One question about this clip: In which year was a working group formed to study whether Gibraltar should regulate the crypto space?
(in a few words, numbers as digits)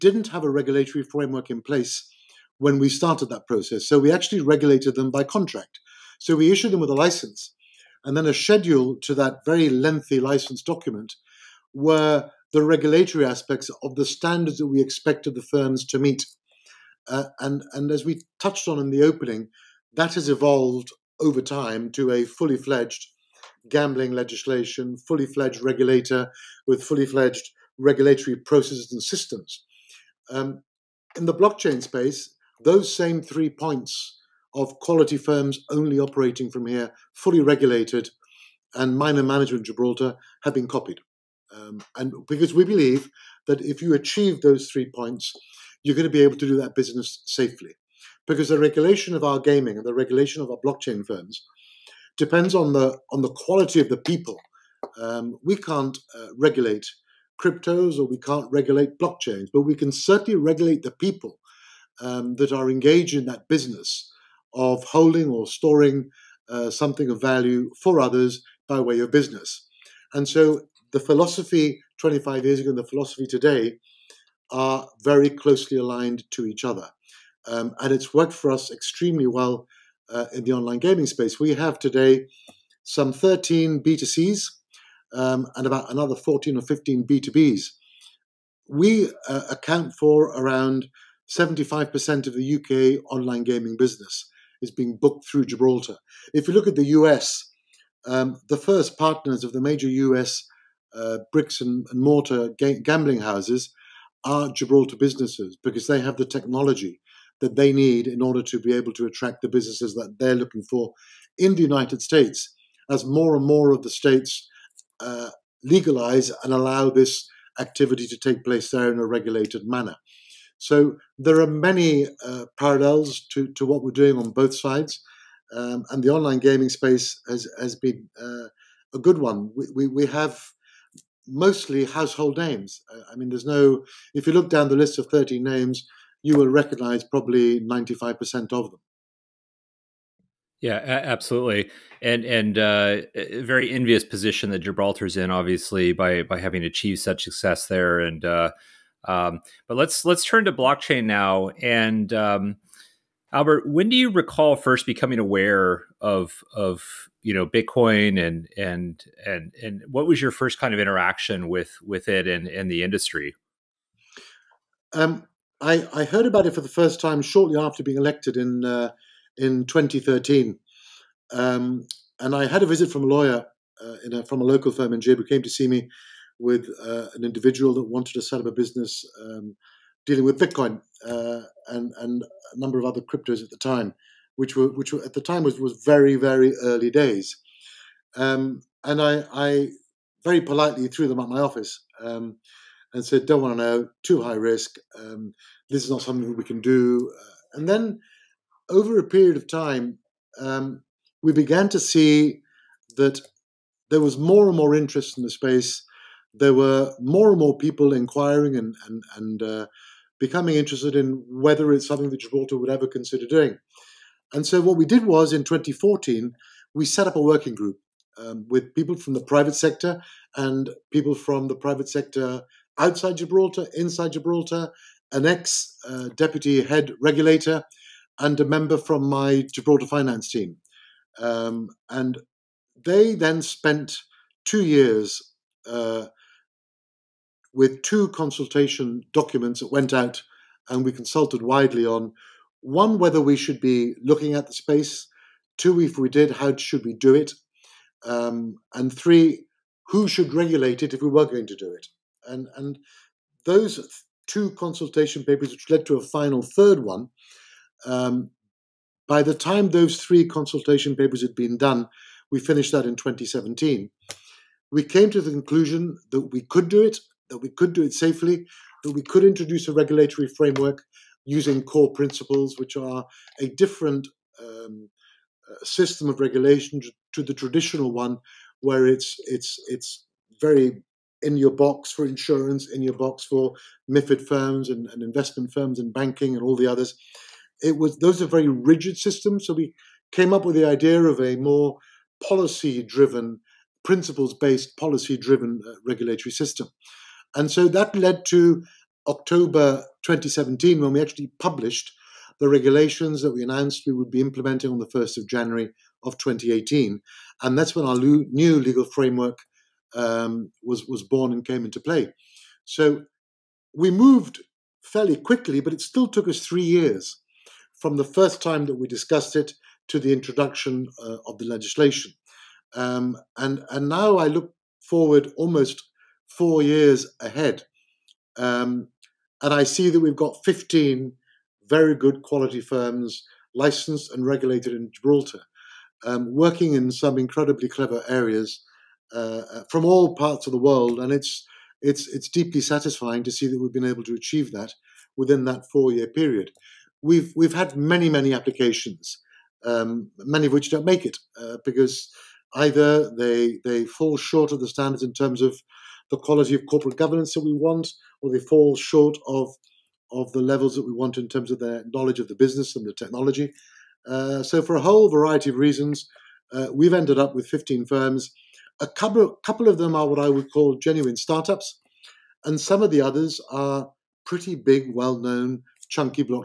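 2014.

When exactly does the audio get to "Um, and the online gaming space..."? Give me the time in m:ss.
2:05.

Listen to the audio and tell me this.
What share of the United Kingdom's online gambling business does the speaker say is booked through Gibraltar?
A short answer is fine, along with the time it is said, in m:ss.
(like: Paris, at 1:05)
75%, at 1:31.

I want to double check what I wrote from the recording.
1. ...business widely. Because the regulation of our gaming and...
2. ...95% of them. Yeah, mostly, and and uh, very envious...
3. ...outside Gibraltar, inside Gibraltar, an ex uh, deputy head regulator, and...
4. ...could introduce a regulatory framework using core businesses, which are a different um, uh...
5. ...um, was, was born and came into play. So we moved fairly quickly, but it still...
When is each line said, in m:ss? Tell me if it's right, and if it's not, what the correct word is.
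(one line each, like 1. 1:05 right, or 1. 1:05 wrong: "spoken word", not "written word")
1. 0:46 wrong: "safely", not "widely"
2. 2:17 wrong: "absolutely", not "mostly"
3. 3:42 right
4. 4:29 wrong: "principles", not "businesses"
5. 5:09 right.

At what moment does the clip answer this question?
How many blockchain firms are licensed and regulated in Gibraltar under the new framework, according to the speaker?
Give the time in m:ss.
5:30.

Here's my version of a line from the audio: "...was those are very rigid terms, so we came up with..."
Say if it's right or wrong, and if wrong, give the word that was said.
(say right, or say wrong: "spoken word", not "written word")
wrong: "systems", not "terms".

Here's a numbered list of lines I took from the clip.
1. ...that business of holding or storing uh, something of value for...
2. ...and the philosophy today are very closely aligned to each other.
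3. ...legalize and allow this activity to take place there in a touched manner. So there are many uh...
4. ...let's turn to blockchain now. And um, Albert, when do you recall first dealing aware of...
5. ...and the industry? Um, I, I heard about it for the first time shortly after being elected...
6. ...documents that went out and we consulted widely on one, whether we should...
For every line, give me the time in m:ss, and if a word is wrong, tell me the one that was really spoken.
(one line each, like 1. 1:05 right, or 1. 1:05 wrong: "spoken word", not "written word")
1. 1:03 right
2. 1:12 right
3. 1:55 wrong: "regulated", not "touched"
4. 2:30 wrong: "becoming", not "dealing"
5. 2:42 right
6. 3:59 right.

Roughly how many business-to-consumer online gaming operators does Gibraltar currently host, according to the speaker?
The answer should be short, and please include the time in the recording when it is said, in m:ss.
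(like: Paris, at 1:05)
13, at 1:23.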